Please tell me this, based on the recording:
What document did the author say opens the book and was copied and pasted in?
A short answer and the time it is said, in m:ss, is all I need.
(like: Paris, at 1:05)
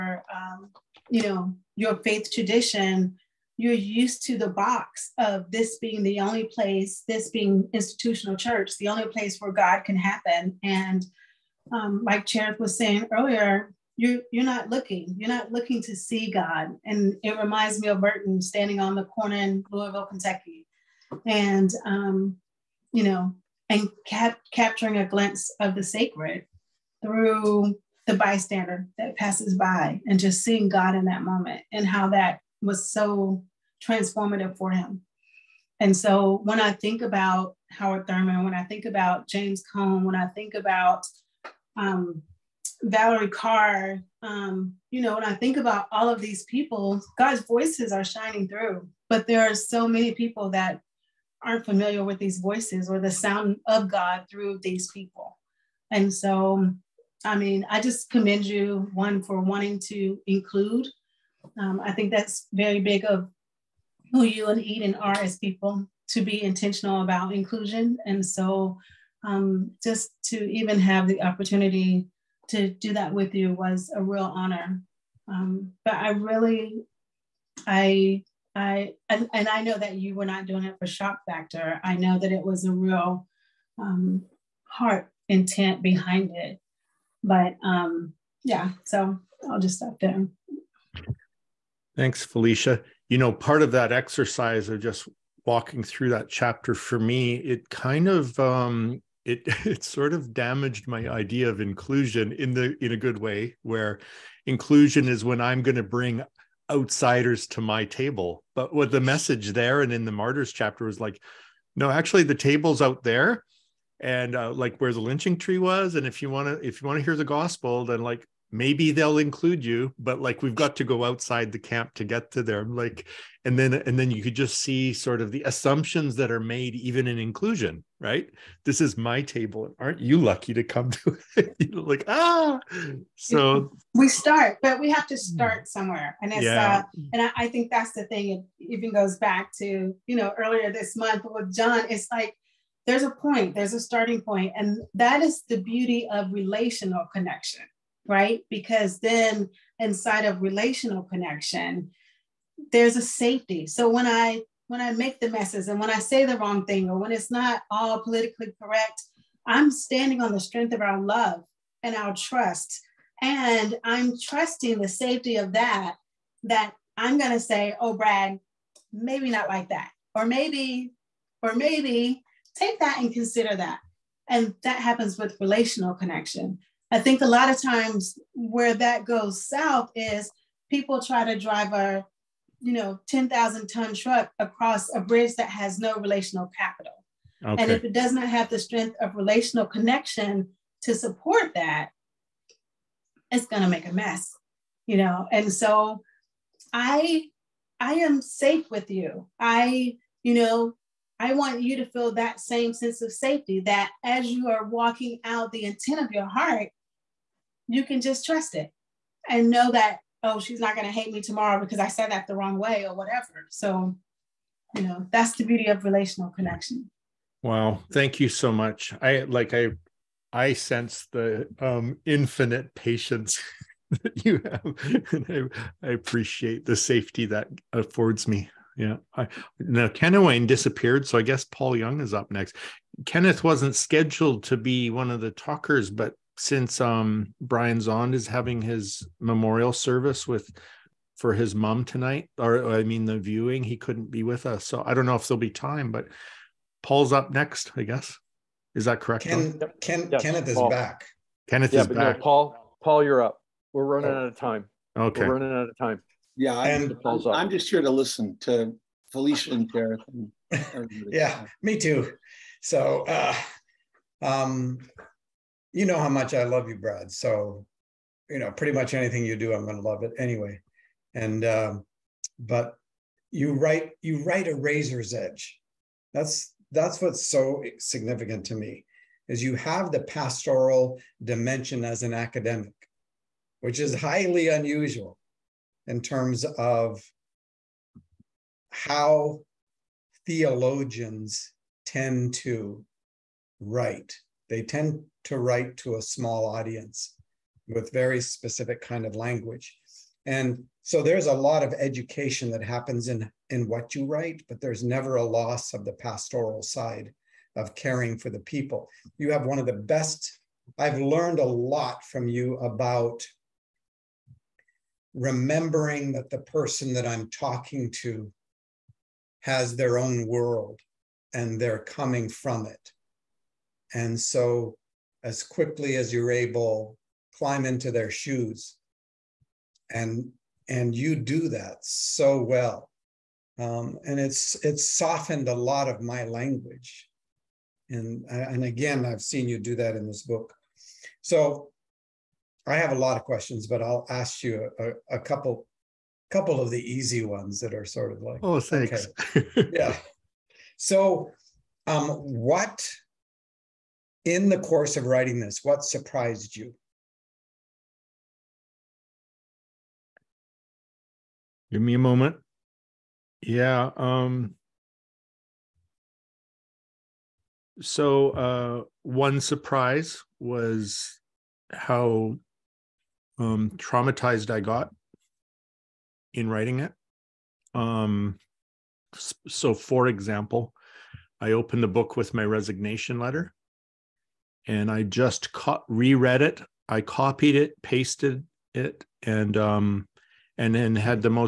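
Resignation letter, at 6:22.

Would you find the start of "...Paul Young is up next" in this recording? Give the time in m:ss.
3:51.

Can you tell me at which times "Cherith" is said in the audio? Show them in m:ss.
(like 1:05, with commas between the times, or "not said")
0:12, 4:19.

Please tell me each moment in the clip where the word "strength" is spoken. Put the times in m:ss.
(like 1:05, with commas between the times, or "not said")
2:40, 3:08.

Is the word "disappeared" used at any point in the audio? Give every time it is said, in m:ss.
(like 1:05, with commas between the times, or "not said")
3:50.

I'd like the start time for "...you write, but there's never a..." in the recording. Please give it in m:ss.
5:03.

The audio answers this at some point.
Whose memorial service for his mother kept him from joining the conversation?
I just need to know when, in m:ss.
3:57.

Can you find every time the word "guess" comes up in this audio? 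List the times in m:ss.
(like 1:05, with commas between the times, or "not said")
3:51, 4:07.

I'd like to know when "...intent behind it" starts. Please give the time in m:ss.
1:25.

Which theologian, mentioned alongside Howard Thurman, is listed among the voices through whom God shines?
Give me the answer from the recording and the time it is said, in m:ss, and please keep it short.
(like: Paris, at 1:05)
James Cone, at 0:39.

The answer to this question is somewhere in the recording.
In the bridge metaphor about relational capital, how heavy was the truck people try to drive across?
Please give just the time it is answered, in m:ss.
3:03.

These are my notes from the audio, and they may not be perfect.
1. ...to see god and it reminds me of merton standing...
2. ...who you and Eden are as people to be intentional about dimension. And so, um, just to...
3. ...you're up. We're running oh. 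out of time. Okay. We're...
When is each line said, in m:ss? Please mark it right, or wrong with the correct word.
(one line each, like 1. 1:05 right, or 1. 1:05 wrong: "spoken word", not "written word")
1. 0:15 right
2. 1:04 wrong: "inclusion", not "dimension"
3. 4:13 right.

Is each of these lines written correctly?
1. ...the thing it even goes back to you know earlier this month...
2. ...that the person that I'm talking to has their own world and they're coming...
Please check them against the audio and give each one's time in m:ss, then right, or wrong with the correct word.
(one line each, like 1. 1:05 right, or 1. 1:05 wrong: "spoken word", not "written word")
1. 2:17 right
2. 5:16 right.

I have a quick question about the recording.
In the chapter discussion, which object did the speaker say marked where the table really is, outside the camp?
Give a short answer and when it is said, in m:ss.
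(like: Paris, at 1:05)
The lynching tree, at 1:54.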